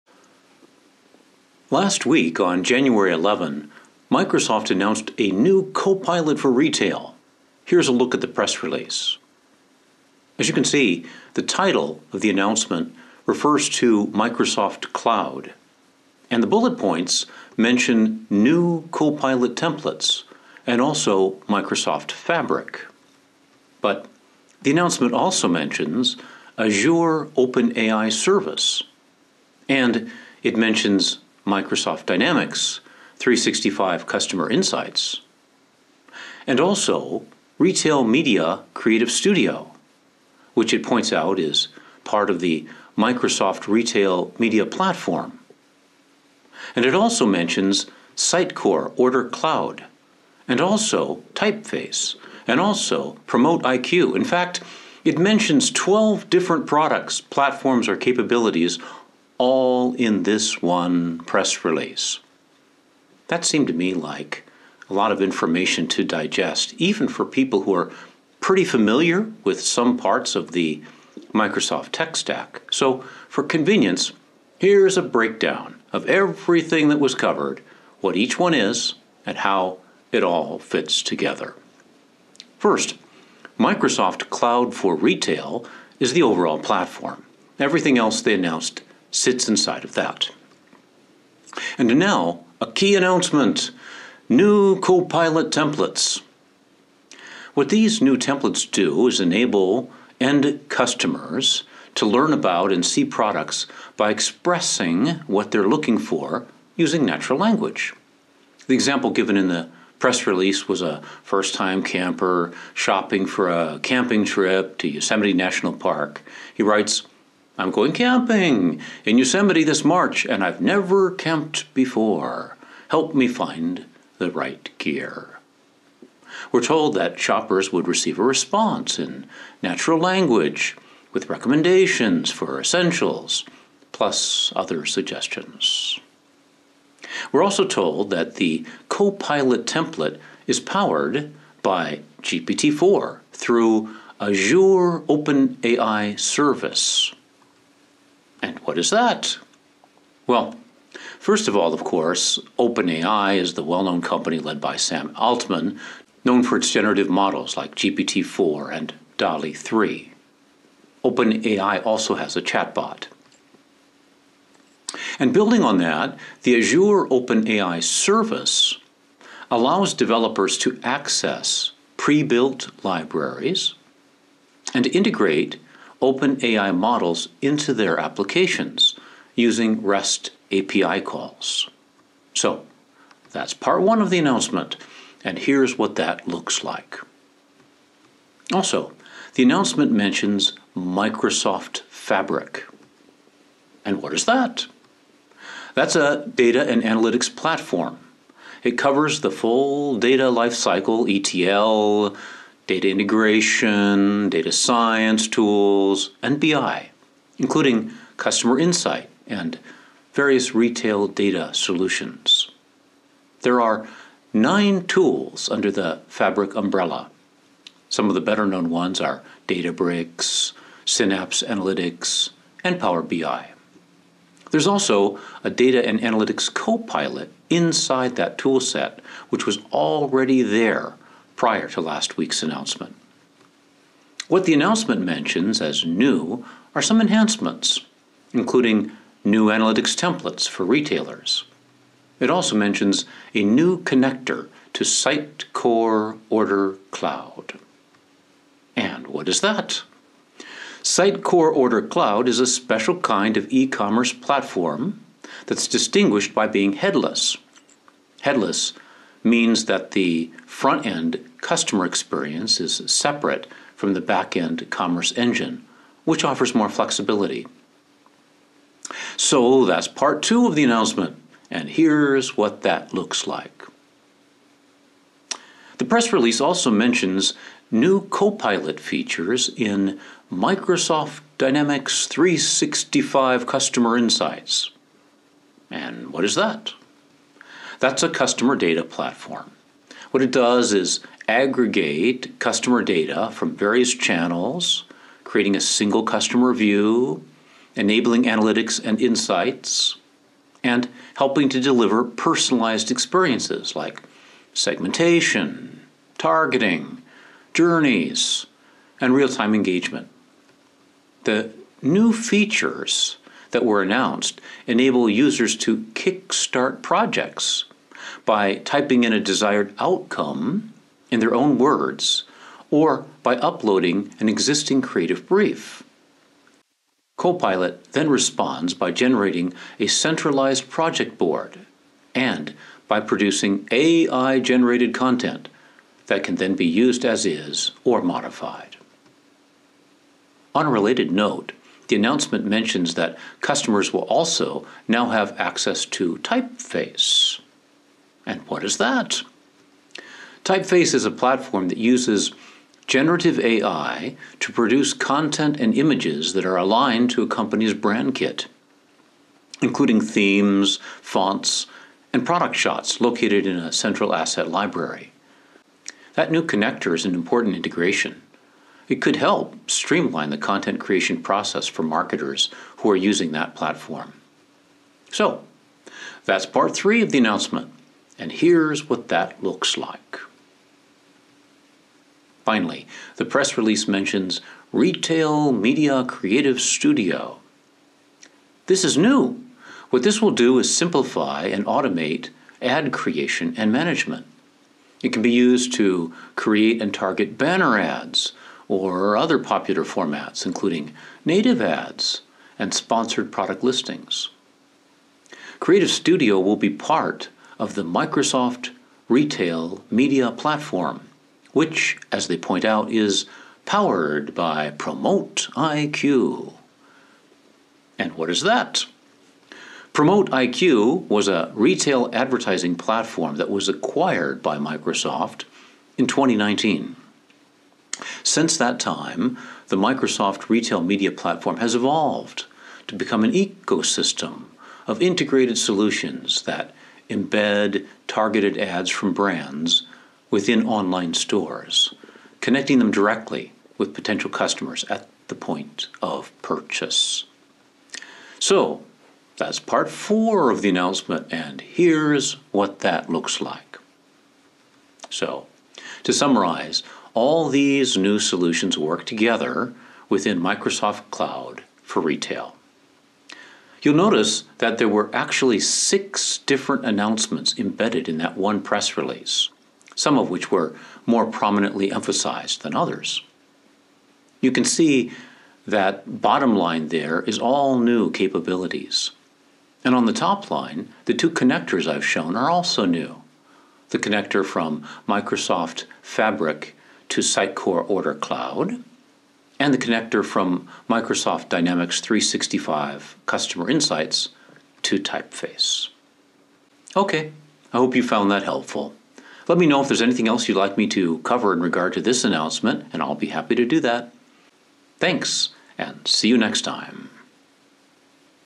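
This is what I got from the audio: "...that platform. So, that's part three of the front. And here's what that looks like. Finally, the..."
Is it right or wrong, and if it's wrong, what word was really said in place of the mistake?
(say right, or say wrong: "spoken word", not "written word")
wrong: "announcement", not "front".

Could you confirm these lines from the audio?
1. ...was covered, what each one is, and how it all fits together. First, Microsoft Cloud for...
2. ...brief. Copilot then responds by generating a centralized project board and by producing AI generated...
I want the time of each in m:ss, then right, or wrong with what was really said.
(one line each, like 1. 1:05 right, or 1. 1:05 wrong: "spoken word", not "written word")
1. 1:16 right
2. 5:25 right.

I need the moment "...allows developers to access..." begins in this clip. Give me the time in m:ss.
2:49.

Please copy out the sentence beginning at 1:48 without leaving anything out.
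The example given in the press release was a first time camper shopping for a camping trip to Yosemite National Park.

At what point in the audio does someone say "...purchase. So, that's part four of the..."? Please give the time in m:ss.
7:26.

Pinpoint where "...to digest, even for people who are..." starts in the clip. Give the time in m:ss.
1:05.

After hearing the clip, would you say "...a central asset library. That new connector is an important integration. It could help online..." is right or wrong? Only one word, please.
wrong.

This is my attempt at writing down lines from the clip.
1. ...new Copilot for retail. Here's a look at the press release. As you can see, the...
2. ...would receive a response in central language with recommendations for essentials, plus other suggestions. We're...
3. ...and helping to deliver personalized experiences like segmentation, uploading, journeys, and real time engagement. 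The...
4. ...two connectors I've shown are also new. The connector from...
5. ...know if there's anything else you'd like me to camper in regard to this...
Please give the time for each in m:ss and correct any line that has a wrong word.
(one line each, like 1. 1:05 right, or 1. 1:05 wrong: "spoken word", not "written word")
1. 0:05 right
2. 2:07 wrong: "natural", not "central"
3. 5:00 wrong: "targeting", not "uploading"
4. 8:01 right
5. 8:19 wrong: "cover", not "camper".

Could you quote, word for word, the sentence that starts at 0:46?
And it also mentions Sitecore Order Cloud, and also Typeface, and also Promote IQ.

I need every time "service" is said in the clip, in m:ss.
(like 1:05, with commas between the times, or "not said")
0:28, 2:26, 2:47.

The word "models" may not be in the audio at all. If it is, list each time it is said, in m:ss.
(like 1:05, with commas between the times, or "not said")
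2:37, 2:56.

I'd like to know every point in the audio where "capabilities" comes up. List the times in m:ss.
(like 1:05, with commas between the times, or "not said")
0:57, 7:58.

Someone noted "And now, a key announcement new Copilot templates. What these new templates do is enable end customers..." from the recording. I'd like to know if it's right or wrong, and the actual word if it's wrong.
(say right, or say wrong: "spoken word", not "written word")
right.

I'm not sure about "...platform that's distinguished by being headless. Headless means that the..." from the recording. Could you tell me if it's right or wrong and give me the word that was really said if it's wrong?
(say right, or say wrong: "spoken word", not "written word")
right.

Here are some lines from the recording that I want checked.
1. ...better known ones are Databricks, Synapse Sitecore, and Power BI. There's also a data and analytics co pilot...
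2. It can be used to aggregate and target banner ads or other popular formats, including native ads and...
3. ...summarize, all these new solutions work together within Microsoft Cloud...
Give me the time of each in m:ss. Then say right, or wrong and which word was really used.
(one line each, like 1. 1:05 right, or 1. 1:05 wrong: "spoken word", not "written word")
1. 3:38 wrong: "Analytics", not "Sitecore"
2. 6:35 wrong: "create", not "aggregate"
3. 7:36 right.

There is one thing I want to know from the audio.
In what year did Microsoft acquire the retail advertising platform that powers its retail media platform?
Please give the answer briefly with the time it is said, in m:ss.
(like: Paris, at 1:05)
2019, at 7:06.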